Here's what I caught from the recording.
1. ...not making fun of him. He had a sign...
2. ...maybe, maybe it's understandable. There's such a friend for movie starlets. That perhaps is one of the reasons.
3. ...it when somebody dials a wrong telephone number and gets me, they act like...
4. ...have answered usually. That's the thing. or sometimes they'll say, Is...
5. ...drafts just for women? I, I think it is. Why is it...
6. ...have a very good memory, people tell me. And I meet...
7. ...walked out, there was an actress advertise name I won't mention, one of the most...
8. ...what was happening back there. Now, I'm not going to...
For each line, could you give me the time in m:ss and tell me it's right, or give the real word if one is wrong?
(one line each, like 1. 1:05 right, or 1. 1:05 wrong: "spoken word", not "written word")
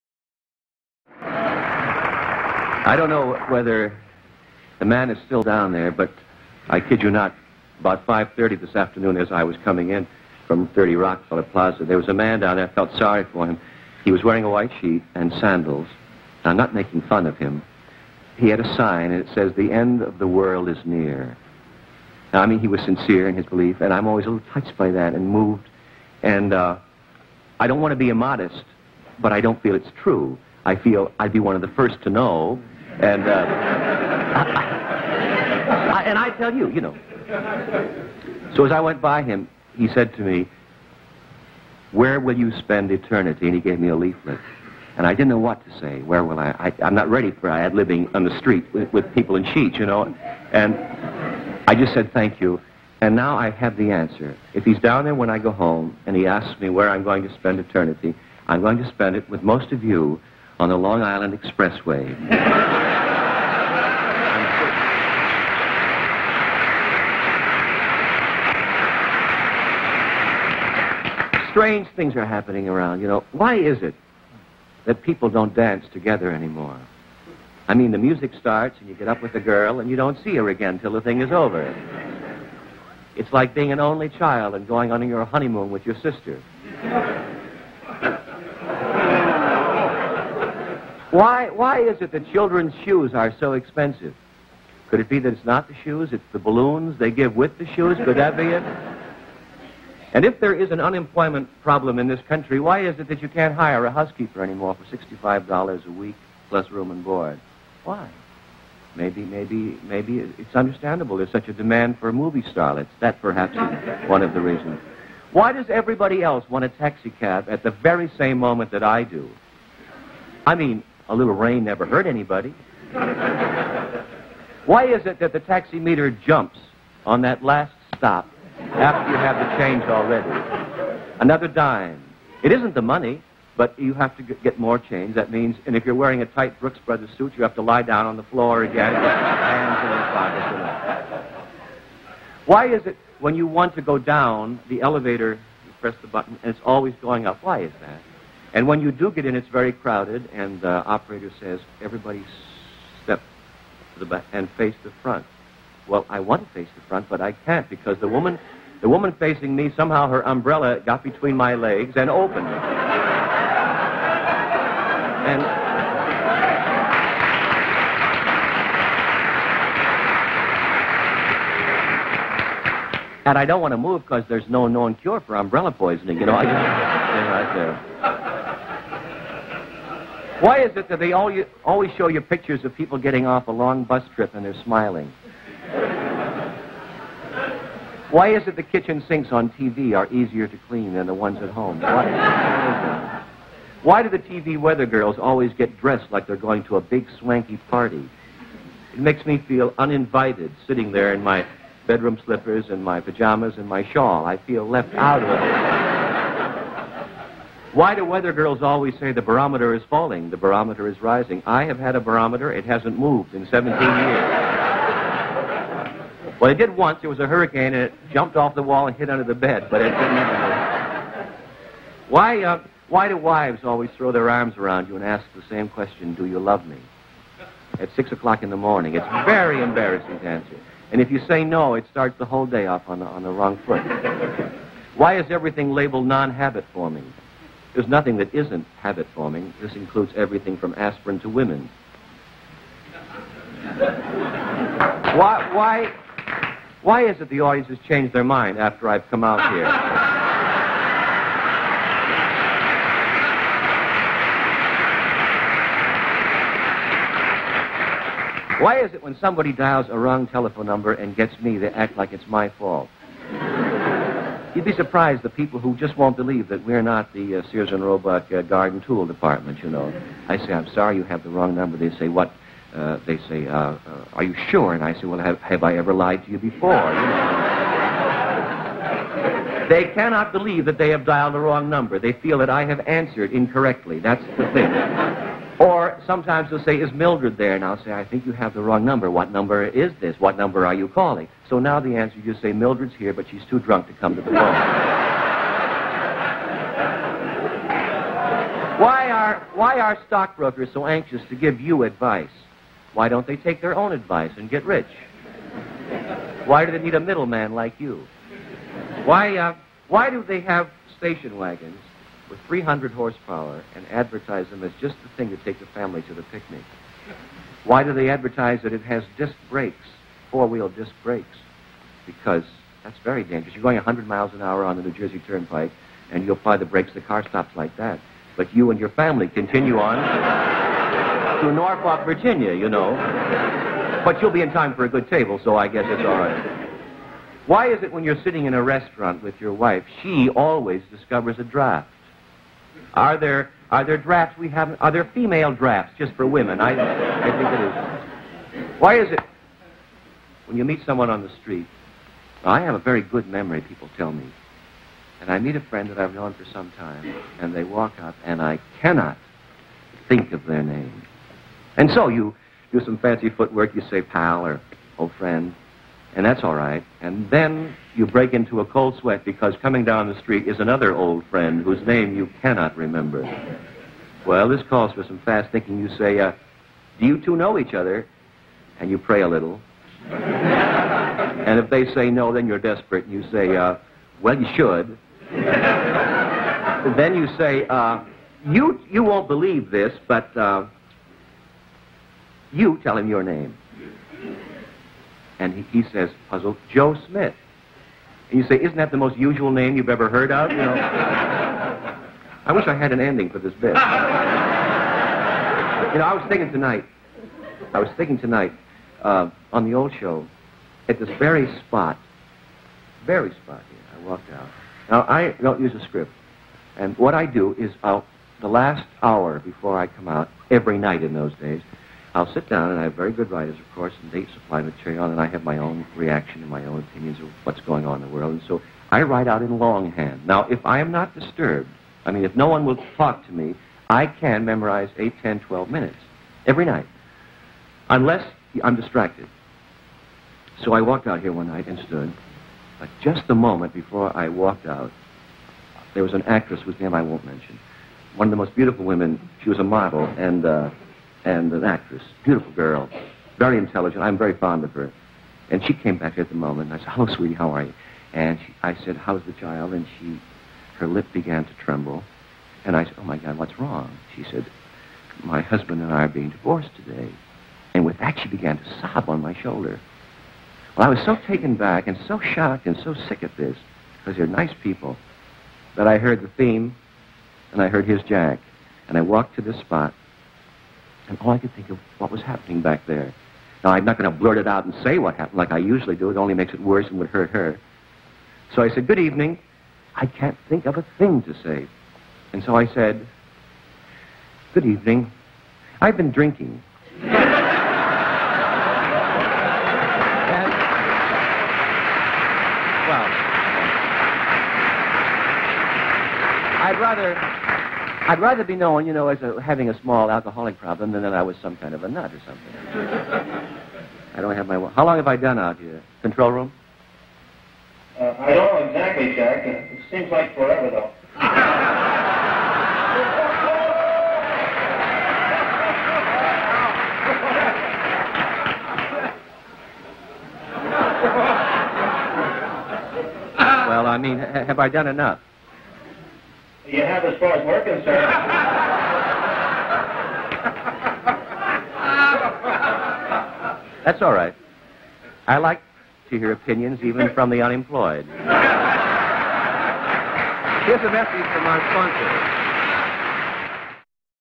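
1. 0:16 right
2. 1:49 wrong: "demand", not "friend"
3. 4:18 right
4. 4:42 wrong: "incorrectly", not "usually"
5. 5:45 right
6. 5:52 right
7. 7:24 wrong: "whose", not "advertise"
8. 8:01 right.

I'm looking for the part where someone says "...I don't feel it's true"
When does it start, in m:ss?
0:29.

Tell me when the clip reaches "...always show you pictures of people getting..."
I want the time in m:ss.
3:01.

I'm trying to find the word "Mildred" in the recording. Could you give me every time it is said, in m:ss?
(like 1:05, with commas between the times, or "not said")
4:46, 4:52.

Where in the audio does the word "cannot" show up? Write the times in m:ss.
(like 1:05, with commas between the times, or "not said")
4:39, 5:58, 6:12.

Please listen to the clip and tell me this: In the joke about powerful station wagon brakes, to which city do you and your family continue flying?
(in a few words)
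Norfolk, Virginia.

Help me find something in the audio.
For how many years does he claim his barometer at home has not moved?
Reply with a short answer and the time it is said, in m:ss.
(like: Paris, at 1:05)
17, at 3:33.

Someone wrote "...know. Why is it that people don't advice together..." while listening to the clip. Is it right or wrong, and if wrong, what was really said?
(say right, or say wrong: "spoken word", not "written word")
wrong: "dance", not "advice".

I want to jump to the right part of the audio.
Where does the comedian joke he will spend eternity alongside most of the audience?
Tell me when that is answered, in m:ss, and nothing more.
1:00.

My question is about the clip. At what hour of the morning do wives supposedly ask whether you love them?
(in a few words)
6 o'clock.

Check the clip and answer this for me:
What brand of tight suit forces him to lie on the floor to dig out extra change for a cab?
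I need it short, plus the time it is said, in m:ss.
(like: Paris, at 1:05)
Brooks Brothers, at 2:16.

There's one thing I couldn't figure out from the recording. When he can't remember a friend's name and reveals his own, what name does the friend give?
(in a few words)
Joe Smith.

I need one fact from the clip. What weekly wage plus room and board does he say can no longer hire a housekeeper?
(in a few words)
$65.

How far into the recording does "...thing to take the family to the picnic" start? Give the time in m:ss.
5:15.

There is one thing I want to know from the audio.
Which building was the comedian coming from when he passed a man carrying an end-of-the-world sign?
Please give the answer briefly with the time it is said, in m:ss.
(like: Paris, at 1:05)
30 Rockefeller Plaza, at 0:10.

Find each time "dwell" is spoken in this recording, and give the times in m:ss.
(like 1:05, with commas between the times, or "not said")
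not said.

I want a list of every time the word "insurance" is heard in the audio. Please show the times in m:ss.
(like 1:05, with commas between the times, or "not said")
not said.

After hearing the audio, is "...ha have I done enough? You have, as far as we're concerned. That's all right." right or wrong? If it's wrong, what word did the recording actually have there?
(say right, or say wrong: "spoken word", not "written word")
right.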